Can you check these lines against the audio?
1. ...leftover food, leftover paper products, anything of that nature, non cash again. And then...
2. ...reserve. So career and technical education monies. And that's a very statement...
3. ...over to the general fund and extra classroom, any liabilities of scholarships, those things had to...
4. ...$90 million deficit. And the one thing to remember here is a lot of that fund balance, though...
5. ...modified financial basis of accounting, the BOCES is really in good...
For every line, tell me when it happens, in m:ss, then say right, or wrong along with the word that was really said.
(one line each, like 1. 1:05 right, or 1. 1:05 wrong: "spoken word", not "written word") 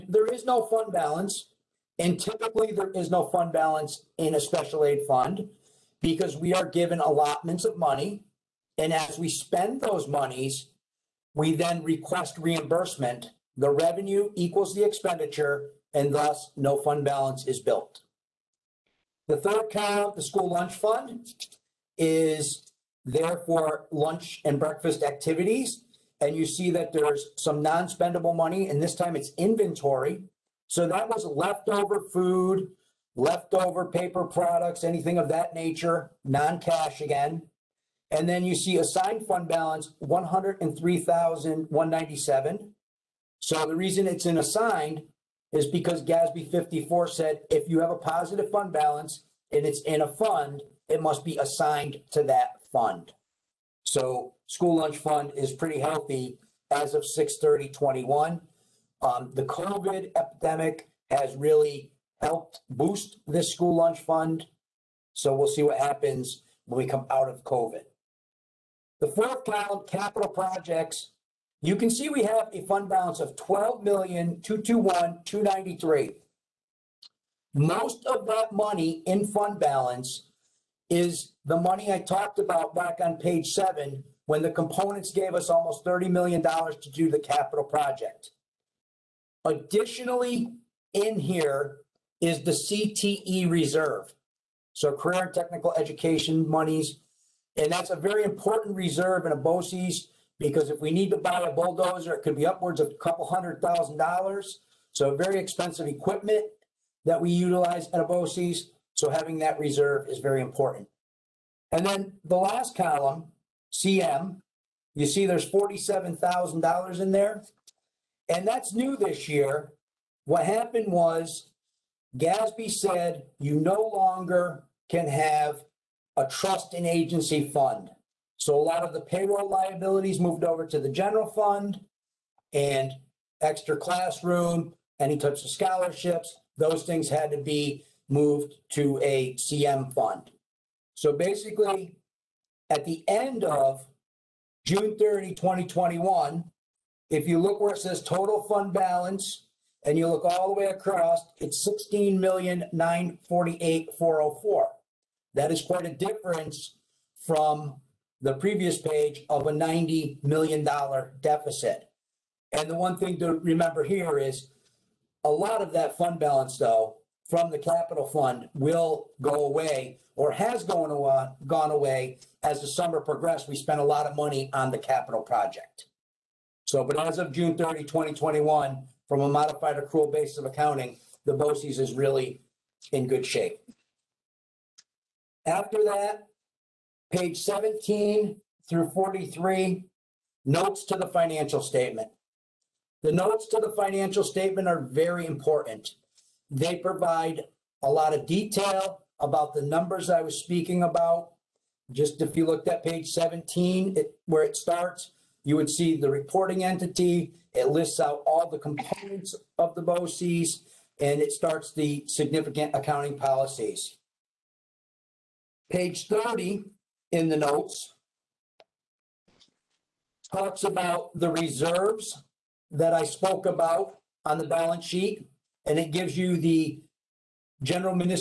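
1. 0:31 right
2. 1:33 wrong: "important", not "statement"
3. 2:10 wrong: "types", not "liabilities"
4. 2:39 right
5. 2:59 wrong: "accrual", not "financial".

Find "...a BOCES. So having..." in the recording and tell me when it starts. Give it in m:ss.
1:47.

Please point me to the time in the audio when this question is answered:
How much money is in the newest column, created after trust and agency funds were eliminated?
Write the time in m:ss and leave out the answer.
1:55.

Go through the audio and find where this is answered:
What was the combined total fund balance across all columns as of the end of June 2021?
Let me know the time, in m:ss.
2:31.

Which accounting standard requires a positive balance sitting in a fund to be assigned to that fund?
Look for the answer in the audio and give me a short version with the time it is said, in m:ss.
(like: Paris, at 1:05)
GASB 54, at 0:46.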